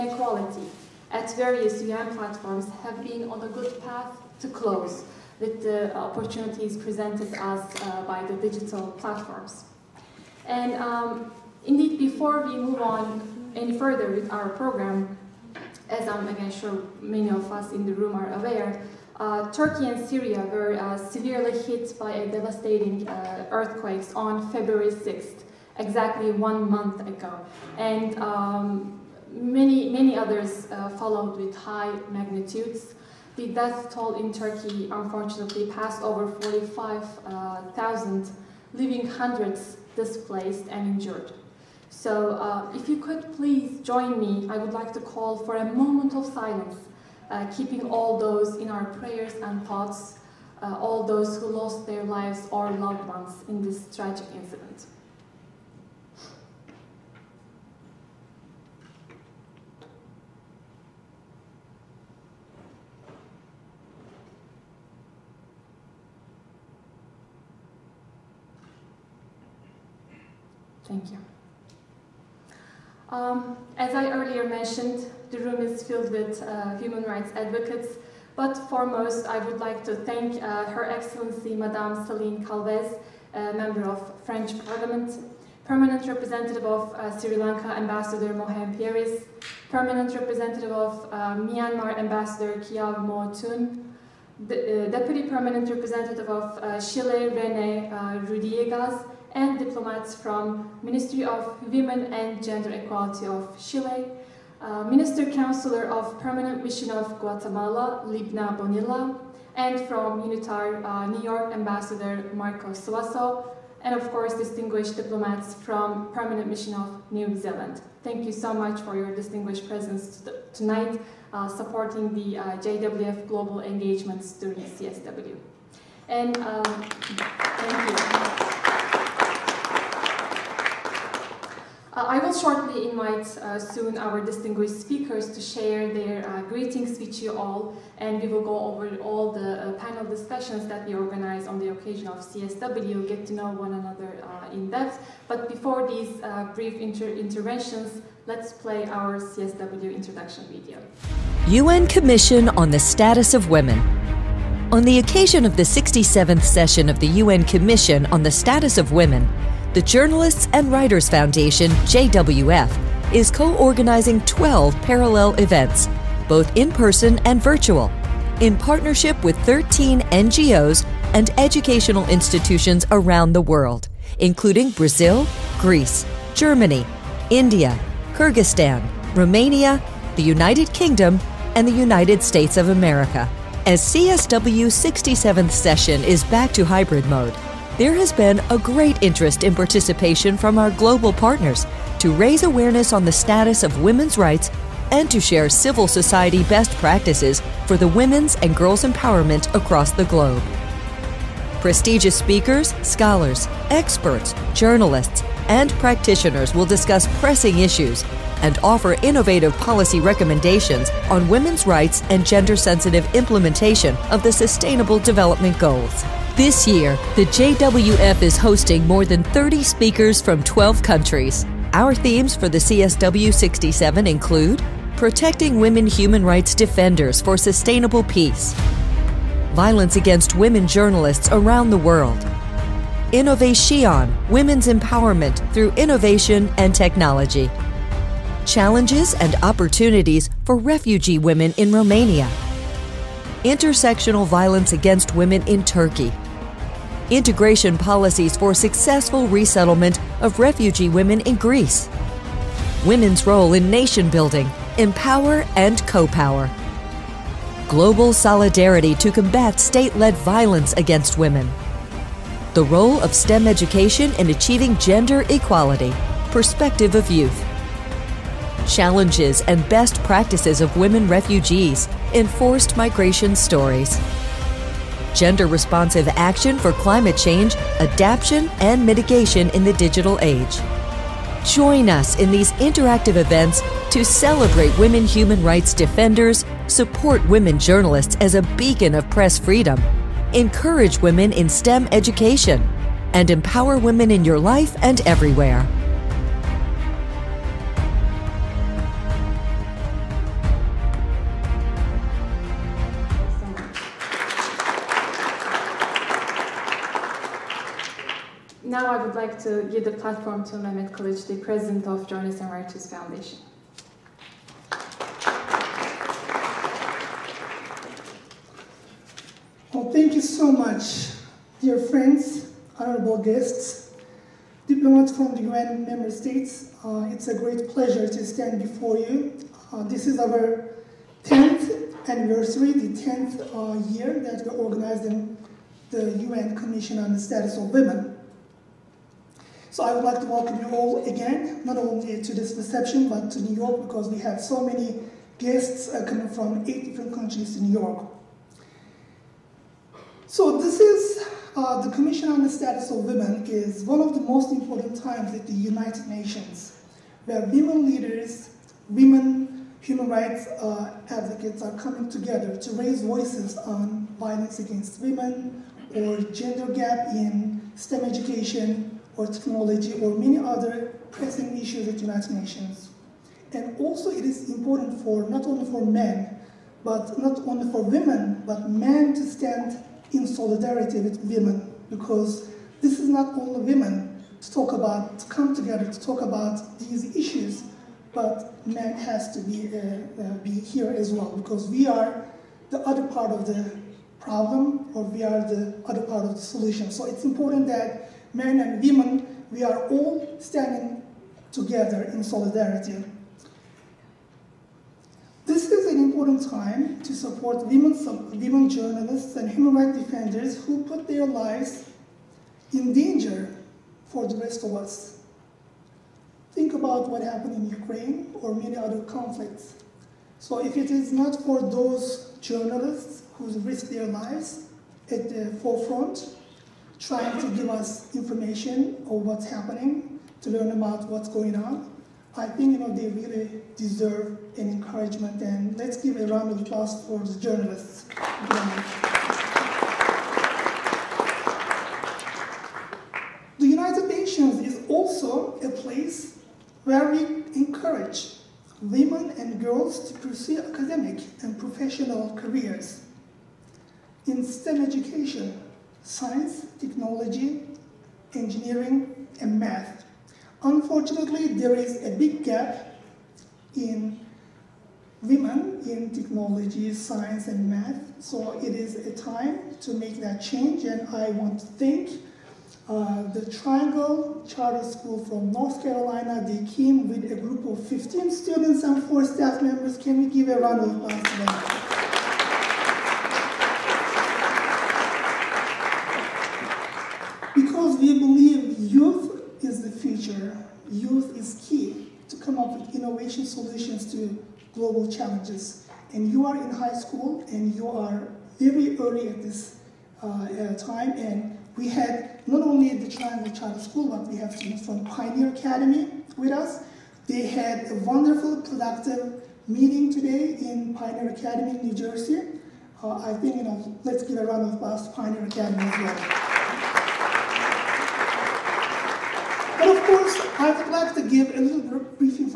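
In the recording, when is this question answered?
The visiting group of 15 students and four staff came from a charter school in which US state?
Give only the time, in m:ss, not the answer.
7:55.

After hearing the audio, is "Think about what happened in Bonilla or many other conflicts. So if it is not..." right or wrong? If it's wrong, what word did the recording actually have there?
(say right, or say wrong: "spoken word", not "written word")
wrong: "Ukraine", not "Bonilla".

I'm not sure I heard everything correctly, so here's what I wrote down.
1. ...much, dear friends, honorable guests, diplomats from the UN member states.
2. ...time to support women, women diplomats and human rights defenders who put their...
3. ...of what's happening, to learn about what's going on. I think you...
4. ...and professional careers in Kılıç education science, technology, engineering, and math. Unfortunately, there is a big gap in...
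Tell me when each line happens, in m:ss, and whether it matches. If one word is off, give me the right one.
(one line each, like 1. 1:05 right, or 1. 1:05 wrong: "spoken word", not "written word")
1. 5:20 right
2. 6:46 wrong: "journalists", not "diplomats"
3. 7:09 right
4. 7:31 wrong: "STEM", not "Kılıç".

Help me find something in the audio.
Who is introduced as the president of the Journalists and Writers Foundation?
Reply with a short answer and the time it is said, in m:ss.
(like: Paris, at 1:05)
Mehmet Kılıç, at 5:10.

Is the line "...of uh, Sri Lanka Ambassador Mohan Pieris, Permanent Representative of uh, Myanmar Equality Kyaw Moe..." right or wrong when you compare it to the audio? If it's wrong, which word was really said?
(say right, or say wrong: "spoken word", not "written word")
wrong: "Ambassador", not "Equality".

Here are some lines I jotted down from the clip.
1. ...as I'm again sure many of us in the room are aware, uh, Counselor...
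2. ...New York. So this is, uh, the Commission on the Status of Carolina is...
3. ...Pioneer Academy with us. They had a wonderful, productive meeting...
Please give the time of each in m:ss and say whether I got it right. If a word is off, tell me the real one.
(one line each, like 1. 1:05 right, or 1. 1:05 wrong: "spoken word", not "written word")
1. 0:15 wrong: "Turkey", not "Counselor"
2. 5:47 wrong: "Women", not "Carolina"
3. 8:25 right.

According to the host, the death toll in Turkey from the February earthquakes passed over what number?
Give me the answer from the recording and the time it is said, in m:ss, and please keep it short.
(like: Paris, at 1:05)
45,000, at 0:36.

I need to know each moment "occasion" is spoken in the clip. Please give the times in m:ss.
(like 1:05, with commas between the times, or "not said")
2:21, 2:34.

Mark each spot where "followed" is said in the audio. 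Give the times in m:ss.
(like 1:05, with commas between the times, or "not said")
0:30.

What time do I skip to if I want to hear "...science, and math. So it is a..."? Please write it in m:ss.
7:46.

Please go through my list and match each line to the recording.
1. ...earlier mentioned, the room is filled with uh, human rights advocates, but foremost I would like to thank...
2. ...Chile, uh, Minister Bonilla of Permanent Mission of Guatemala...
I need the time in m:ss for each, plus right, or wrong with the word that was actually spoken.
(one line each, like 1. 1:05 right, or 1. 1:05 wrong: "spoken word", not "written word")
1. 1:14 right
2. 1:43 wrong: "Counselor", not "Bonilla".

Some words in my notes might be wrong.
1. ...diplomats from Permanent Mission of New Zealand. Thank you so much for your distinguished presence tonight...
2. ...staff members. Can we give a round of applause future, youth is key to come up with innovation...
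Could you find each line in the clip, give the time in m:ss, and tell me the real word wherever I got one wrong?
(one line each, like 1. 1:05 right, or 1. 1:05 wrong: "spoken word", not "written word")
1. 1:54 right
2. 7:59 right.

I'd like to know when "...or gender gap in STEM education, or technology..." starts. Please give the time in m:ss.
6:05.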